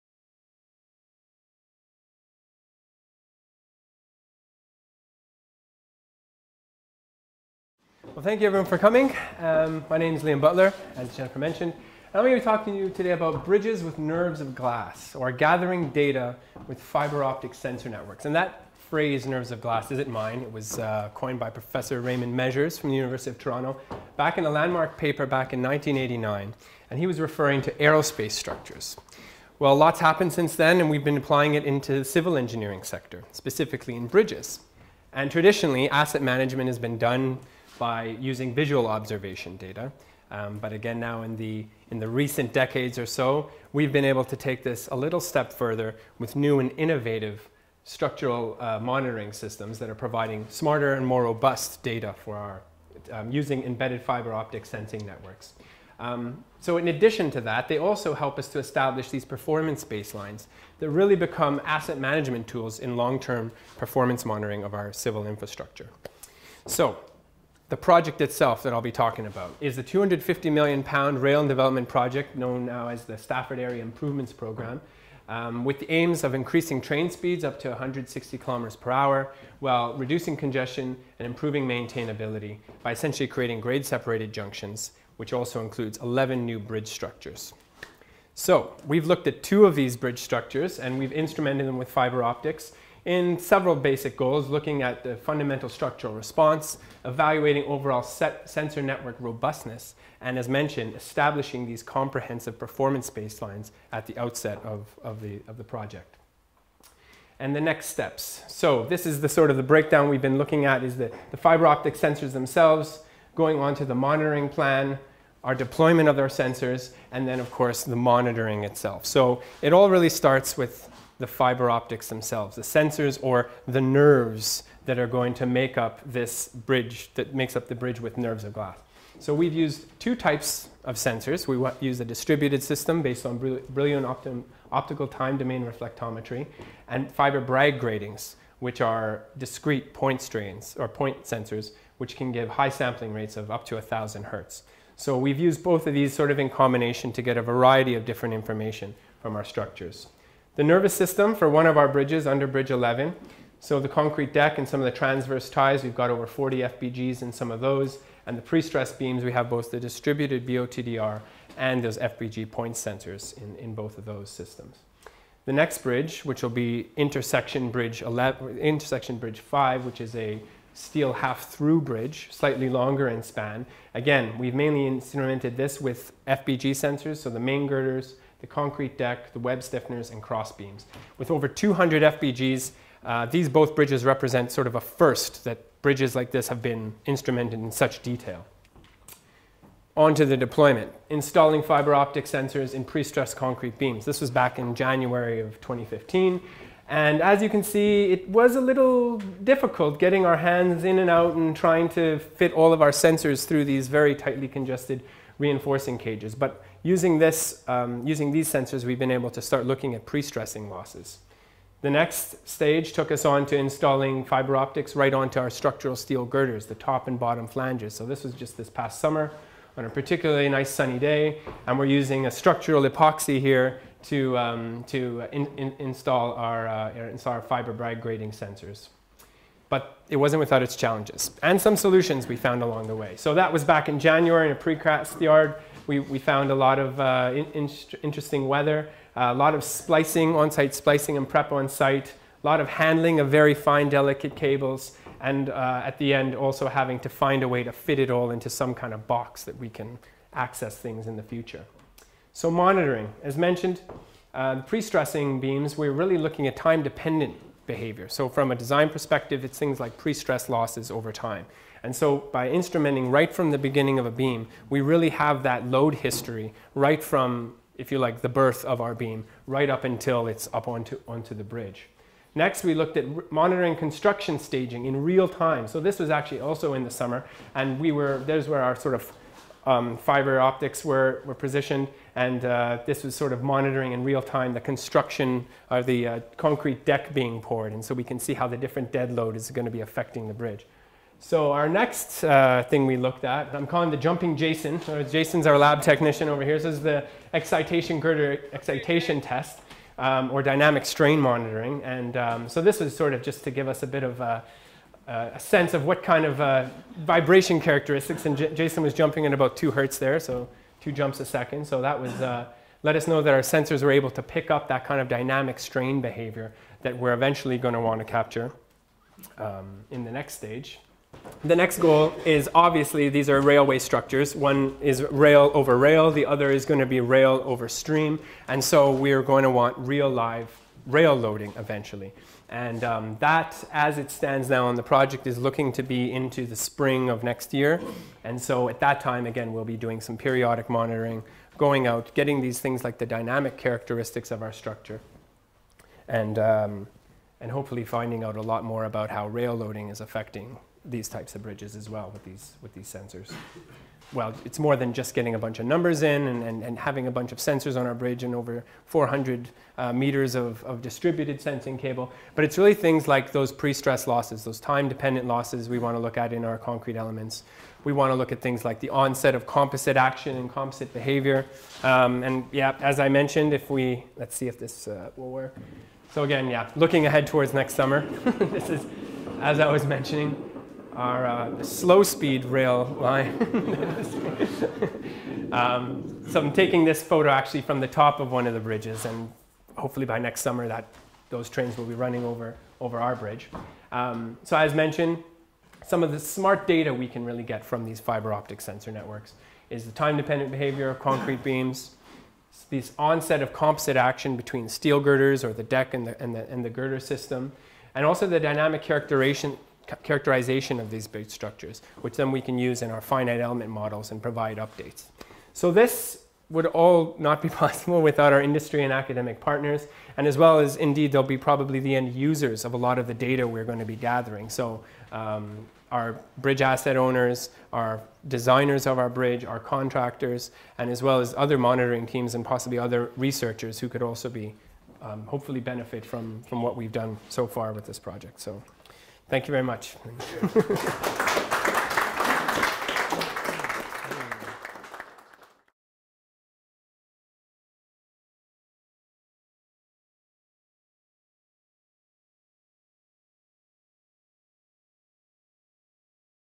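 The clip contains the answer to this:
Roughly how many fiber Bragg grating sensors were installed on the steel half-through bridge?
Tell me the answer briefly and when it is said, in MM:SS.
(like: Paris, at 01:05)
over 200, at 03:01.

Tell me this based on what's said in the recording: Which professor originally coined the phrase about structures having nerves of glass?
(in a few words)
Raymond Measures.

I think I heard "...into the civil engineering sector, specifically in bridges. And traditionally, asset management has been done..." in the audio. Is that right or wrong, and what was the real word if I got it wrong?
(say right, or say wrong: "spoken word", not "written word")
right.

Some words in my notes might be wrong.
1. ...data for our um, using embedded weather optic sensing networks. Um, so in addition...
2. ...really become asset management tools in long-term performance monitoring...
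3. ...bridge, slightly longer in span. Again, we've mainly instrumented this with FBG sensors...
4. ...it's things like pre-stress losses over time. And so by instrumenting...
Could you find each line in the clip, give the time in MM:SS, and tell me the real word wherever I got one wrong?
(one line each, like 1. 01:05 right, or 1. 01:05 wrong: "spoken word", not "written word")
1. 00:51 wrong: "fiber", not "weather"
2. 01:00 right
3. 02:51 right
4. 04:19 right.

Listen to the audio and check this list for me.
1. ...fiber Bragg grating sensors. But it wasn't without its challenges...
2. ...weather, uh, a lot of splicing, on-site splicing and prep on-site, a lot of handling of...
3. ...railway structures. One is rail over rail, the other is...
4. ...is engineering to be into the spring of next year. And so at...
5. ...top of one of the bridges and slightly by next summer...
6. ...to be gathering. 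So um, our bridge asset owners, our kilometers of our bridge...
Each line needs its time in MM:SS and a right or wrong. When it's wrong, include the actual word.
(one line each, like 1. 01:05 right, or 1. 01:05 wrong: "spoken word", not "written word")
1. 03:47 right
2. 03:58 right
3. 05:23 right
4. 05:35 wrong: "looking", not "engineering"
5. 06:27 wrong: "hopefully", not "slightly"
6. 07:03 wrong: "designers", not "kilometers".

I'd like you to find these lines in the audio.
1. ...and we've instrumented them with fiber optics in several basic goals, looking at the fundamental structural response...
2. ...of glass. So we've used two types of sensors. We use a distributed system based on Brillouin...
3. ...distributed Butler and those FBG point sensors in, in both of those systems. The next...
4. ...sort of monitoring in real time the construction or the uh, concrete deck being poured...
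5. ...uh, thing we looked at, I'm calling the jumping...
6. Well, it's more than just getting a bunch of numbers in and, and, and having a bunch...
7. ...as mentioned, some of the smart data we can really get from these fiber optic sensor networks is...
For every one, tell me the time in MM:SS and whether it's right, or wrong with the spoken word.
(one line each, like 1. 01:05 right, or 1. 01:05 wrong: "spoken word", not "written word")
1. 01:30 right
2. 02:08 right
3. 02:39 wrong: "BOTDR", not "Butler"
4. 04:43 right
5. 04:52 right
6. 05:54 right
7. 06:34 right.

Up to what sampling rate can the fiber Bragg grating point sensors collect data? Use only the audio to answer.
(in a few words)
1,000 hertz.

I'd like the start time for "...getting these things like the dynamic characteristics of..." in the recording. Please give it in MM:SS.
05:42.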